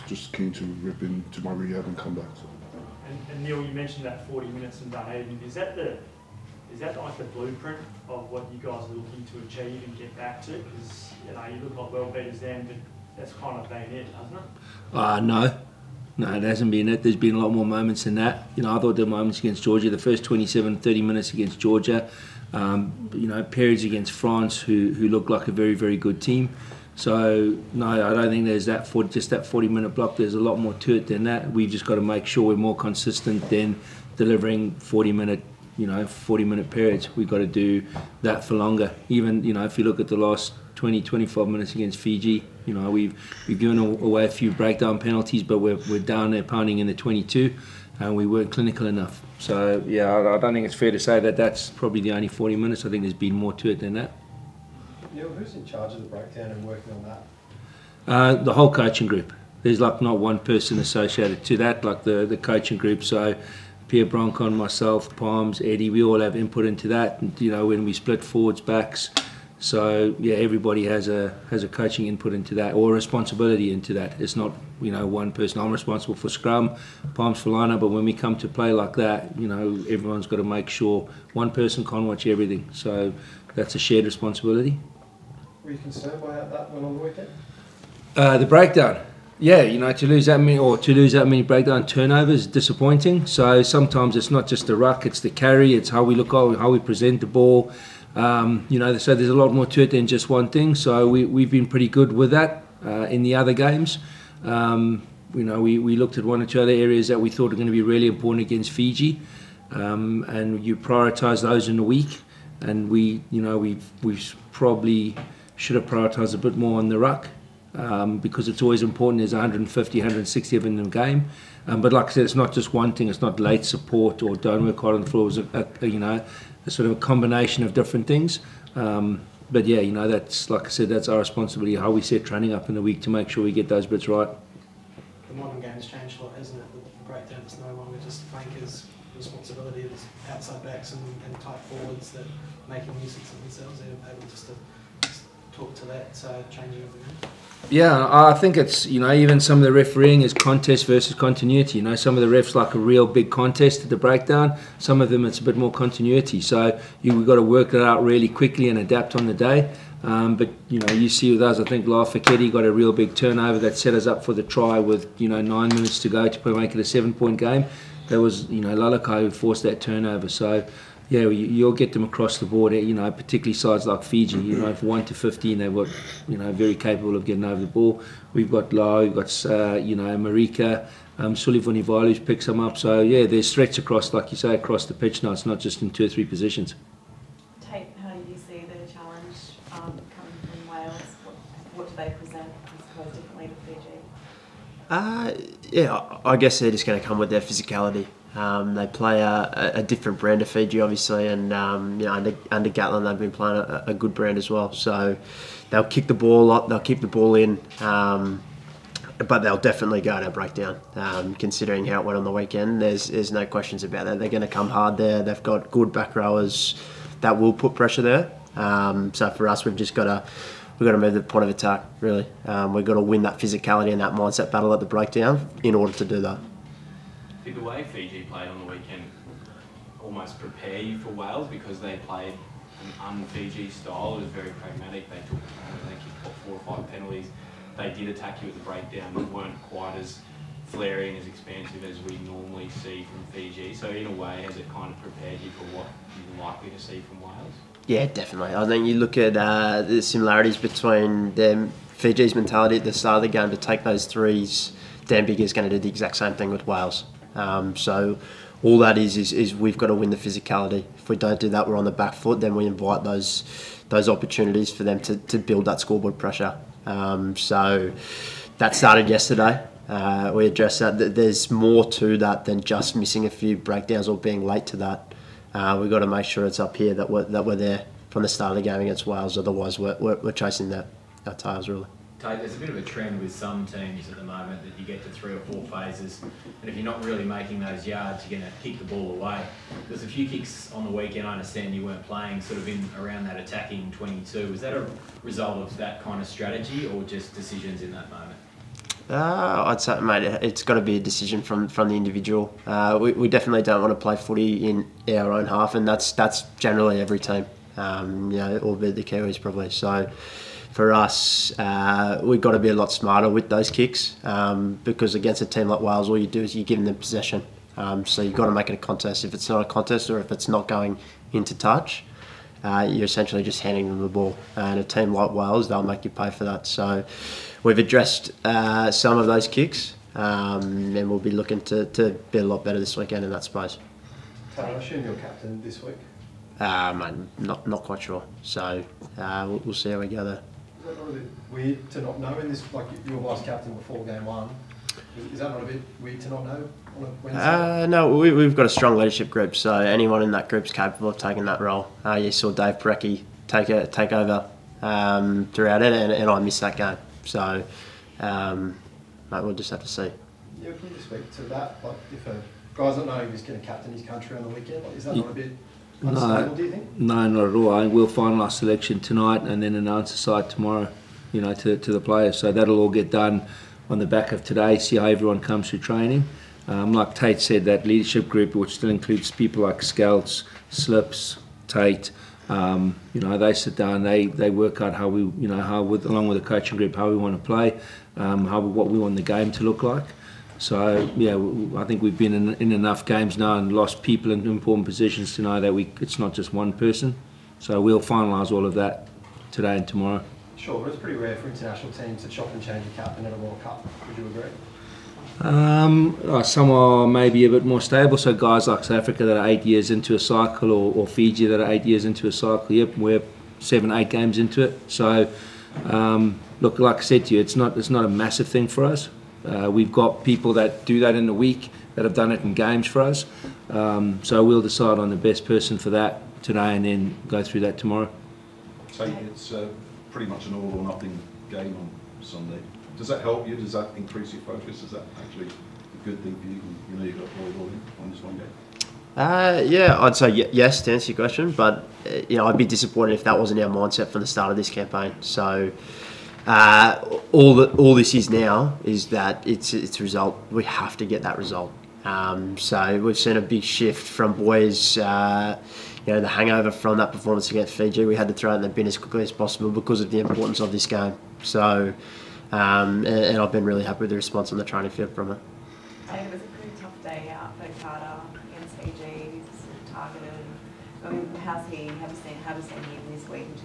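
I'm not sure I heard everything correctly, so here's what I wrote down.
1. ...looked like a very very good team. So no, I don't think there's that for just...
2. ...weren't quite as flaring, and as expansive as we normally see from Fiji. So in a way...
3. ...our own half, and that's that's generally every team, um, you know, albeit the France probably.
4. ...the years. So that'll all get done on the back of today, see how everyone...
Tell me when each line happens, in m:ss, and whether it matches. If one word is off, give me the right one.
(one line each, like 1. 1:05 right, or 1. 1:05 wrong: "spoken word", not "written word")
1. 0:25 right
2. 3:59 right
3. 5:05 wrong: "Kiwis", not "France"
4. 6:11 wrong: "players", not "years".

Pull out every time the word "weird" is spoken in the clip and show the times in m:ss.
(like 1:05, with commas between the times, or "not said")
5:41, 5:46.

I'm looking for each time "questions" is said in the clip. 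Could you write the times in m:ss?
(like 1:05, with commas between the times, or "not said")
3:33, 7:21.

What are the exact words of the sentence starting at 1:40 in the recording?
So we, we've been pretty good with that uh, in the other games.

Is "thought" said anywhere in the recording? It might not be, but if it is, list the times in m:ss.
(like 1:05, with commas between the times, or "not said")
0:18, 1:47.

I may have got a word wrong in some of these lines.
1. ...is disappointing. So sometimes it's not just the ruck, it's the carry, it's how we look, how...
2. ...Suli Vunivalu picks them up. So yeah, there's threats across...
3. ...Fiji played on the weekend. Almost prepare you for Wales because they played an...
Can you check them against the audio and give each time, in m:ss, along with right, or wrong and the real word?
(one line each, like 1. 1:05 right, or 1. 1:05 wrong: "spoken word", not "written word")
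1. 1:32 right
2. 3:01 right
3. 3:47 right.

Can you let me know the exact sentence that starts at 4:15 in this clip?
Dan Biggar's going to do the exact same thing with Wales.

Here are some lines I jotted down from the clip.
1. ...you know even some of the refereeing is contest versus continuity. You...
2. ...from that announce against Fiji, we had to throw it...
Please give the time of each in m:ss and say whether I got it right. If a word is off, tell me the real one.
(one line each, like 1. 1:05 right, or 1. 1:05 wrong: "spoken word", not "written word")
1. 2:28 right
2. 7:36 wrong: "performance", not "announce".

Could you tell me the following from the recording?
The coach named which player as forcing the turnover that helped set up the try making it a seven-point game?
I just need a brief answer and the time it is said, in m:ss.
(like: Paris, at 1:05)
Lalakai, at 2:48.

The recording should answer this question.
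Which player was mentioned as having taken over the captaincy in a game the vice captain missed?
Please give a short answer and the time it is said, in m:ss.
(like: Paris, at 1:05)
Dave Porecki, at 5:52.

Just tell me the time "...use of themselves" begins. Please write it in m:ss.
2:23.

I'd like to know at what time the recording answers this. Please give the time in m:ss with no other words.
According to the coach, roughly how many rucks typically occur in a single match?
1:59.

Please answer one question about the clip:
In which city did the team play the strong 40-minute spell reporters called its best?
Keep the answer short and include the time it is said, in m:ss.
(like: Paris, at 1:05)
Dunedin, at 0:04.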